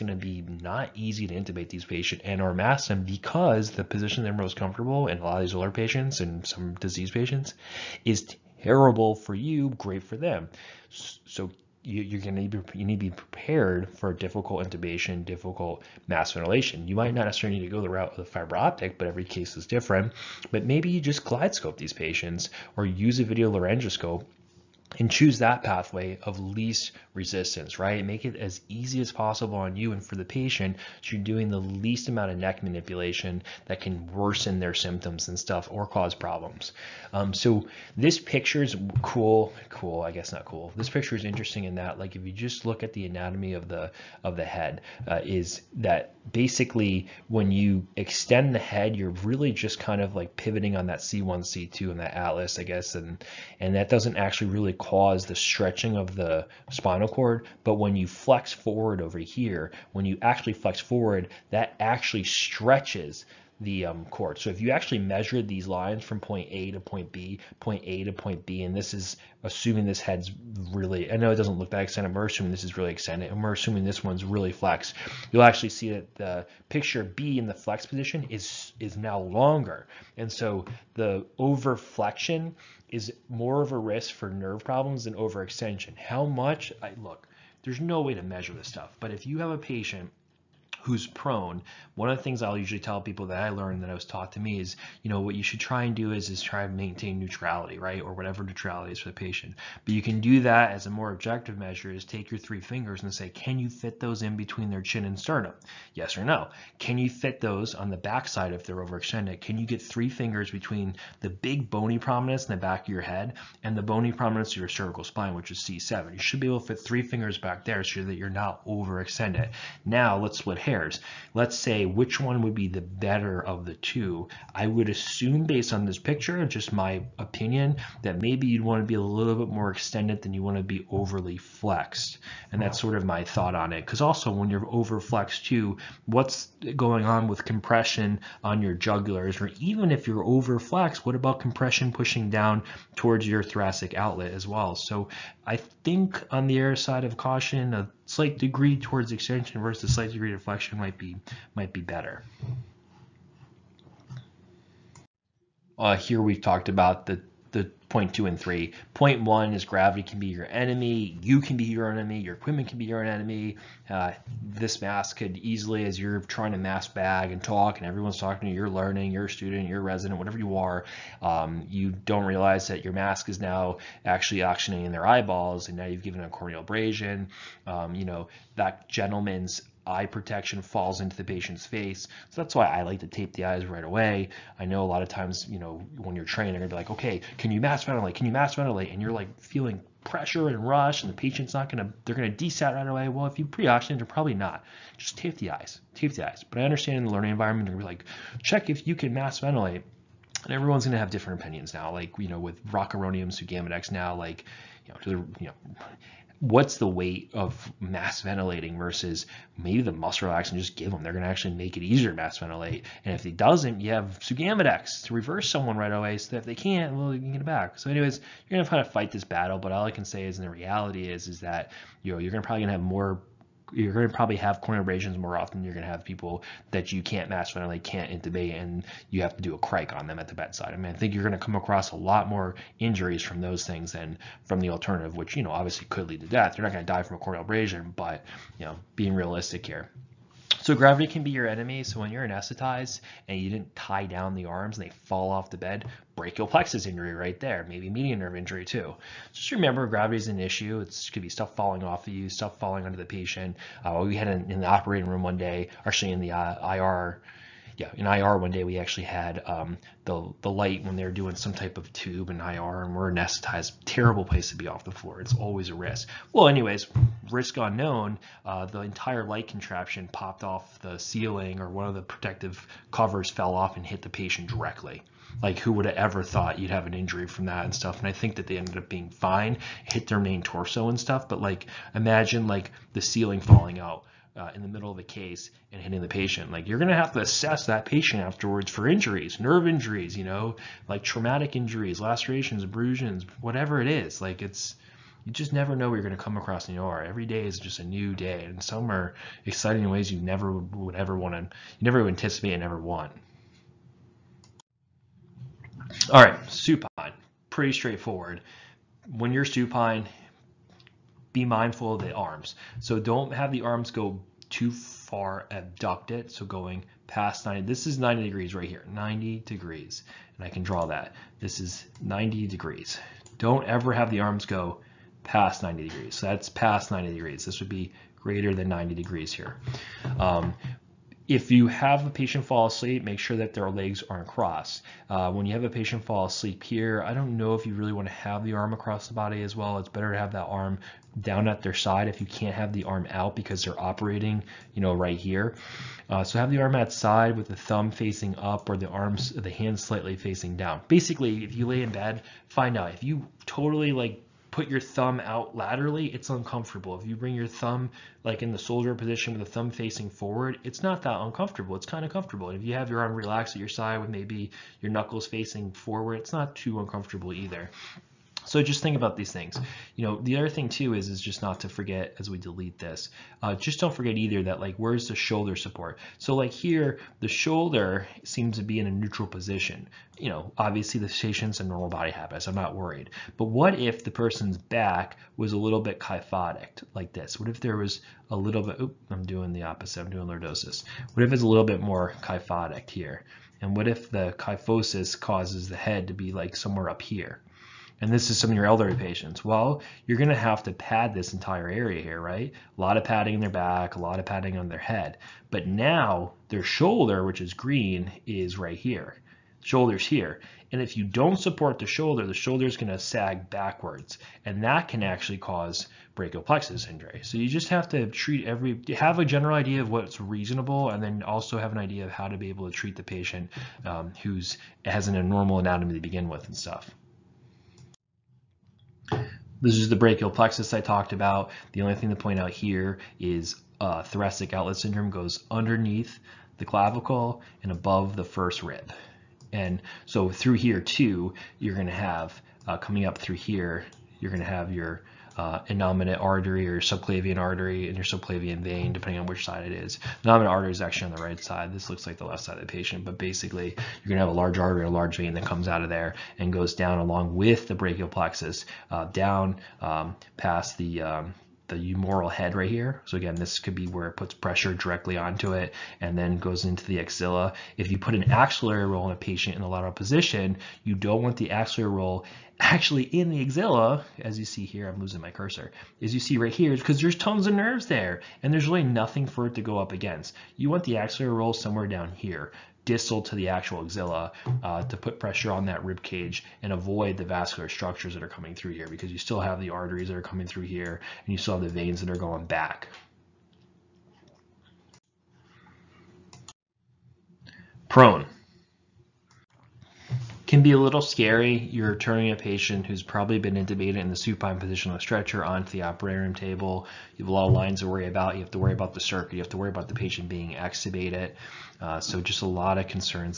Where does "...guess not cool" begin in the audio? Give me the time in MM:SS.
00:40.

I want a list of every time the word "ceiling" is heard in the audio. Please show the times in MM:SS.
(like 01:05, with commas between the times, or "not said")
04:30, 04:43.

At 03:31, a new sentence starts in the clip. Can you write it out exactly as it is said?
They're going to actually make it easier to mass ventilate.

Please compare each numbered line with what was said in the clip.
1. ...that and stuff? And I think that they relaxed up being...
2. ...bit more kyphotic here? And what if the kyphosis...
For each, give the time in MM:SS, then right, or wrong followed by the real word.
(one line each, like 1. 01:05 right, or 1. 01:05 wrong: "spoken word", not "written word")
1. 04:37 wrong: "ended", not "relaxed"
2. 06:31 right.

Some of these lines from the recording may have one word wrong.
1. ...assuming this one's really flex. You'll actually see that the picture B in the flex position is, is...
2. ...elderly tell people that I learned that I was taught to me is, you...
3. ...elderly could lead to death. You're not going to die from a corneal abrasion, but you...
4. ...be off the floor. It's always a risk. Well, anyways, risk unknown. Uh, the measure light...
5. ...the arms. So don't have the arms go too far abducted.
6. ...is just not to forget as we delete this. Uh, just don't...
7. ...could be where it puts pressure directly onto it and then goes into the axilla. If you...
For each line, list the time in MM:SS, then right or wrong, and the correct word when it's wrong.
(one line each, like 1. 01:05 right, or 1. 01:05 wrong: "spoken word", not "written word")
1. 01:13 right
2. 01:32 wrong: "usually", not "elderly"
3. 03:55 wrong: "obviously", not "elderly"
4. 04:24 wrong: "entire", not "measure"
5. 05:12 right
6. 06:11 right
7. 07:43 right.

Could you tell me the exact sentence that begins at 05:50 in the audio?
Basically, if you lay in bed, find out if you totally like put your thumb out laterally, it's uncomfortable.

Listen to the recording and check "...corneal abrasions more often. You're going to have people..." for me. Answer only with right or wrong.
right.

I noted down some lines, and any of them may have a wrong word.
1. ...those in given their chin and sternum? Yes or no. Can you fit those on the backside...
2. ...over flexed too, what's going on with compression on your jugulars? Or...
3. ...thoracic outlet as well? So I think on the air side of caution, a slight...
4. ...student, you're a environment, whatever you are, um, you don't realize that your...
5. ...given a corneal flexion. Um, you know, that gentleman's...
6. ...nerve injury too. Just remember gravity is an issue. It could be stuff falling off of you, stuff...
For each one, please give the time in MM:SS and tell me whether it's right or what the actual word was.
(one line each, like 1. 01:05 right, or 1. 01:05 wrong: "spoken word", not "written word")
1. 01:44 wrong: "between", not "given"
2. 02:14 right
3. 02:23 right
4. 02:49 wrong: "resident", not "environment"
5. 02:56 wrong: "abrasion", not "flexion"
6. 04:08 right.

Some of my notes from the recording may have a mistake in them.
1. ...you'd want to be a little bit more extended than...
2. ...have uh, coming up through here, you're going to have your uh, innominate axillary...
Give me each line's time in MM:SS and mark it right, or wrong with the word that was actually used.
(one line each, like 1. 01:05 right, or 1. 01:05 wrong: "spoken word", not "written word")
1. 02:08 right
2. 07:21 wrong: "artery", not "axillary".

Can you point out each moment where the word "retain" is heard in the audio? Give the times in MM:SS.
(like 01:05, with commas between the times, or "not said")
not said.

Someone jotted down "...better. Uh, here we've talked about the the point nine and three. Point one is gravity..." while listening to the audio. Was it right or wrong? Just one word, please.
wrong.